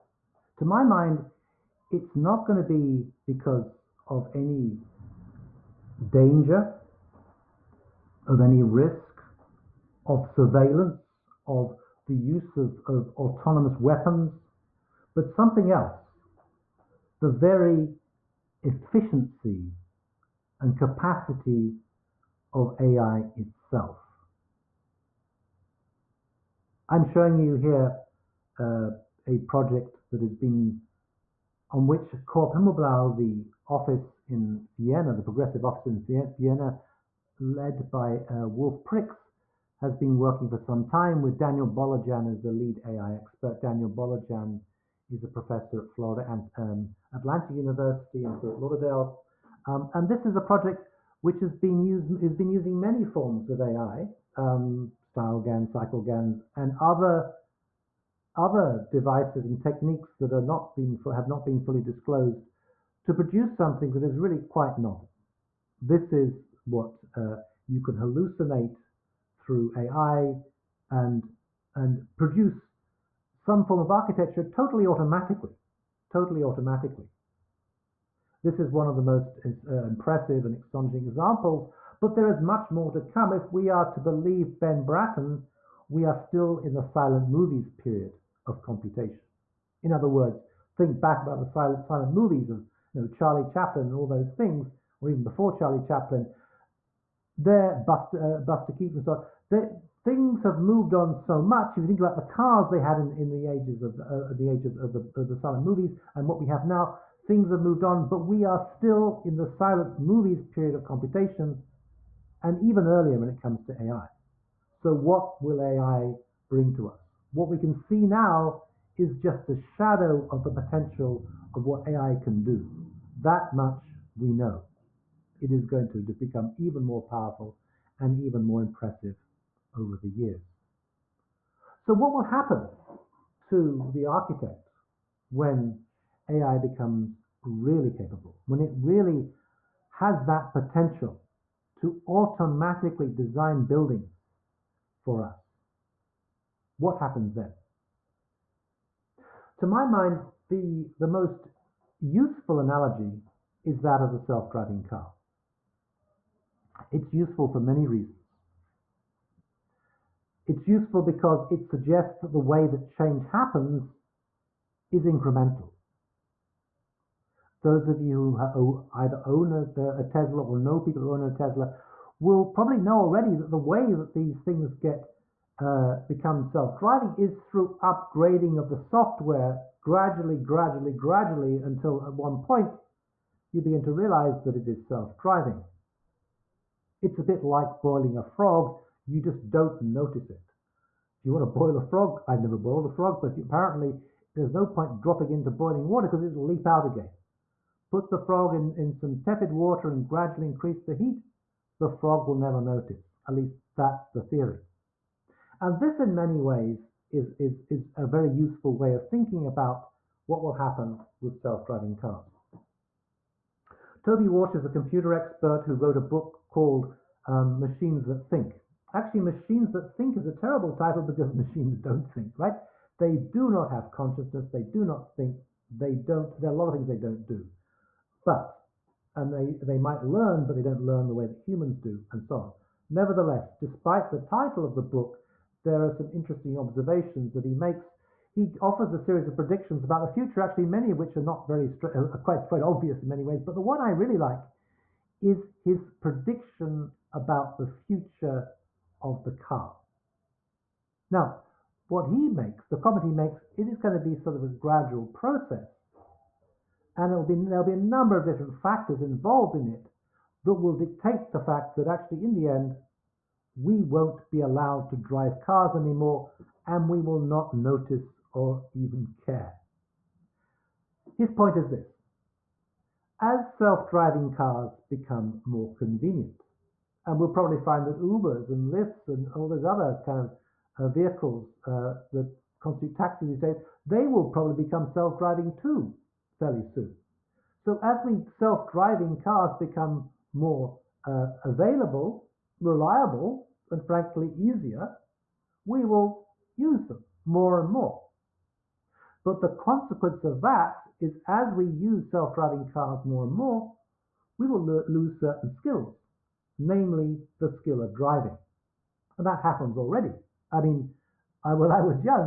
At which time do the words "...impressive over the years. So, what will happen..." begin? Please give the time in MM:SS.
02:08.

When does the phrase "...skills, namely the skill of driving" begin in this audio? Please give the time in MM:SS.
05:05.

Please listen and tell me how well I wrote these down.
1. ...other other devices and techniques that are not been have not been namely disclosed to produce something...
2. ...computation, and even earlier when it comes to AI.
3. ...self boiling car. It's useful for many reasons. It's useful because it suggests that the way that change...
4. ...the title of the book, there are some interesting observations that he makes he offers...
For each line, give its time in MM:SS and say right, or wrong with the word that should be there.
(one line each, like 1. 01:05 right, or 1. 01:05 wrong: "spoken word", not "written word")
1. 00:56 wrong: "fully", not "namely"
2. 01:50 right
3. 02:34 wrong: "driving", not "boiling"
4. 03:54 right.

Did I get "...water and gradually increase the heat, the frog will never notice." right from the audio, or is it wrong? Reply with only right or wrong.
right.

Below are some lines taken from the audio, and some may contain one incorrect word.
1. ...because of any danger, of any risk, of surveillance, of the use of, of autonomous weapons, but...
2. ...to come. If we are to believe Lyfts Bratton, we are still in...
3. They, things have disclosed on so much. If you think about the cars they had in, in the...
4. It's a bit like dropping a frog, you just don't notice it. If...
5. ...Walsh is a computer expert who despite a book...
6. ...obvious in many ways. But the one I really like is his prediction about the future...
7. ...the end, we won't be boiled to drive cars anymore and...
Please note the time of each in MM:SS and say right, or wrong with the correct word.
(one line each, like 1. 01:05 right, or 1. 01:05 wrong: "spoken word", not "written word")
1. 00:03 right
2. 01:22 wrong: "Ben", not "Lyfts"
3. 01:39 wrong: "moved", not "disclosed"
4. 03:07 wrong: "boiling", not "dropping"
5. 03:34 wrong: "wrote", not "despite"
6. 04:02 right
7. 04:22 wrong: "allowed", not "boiled".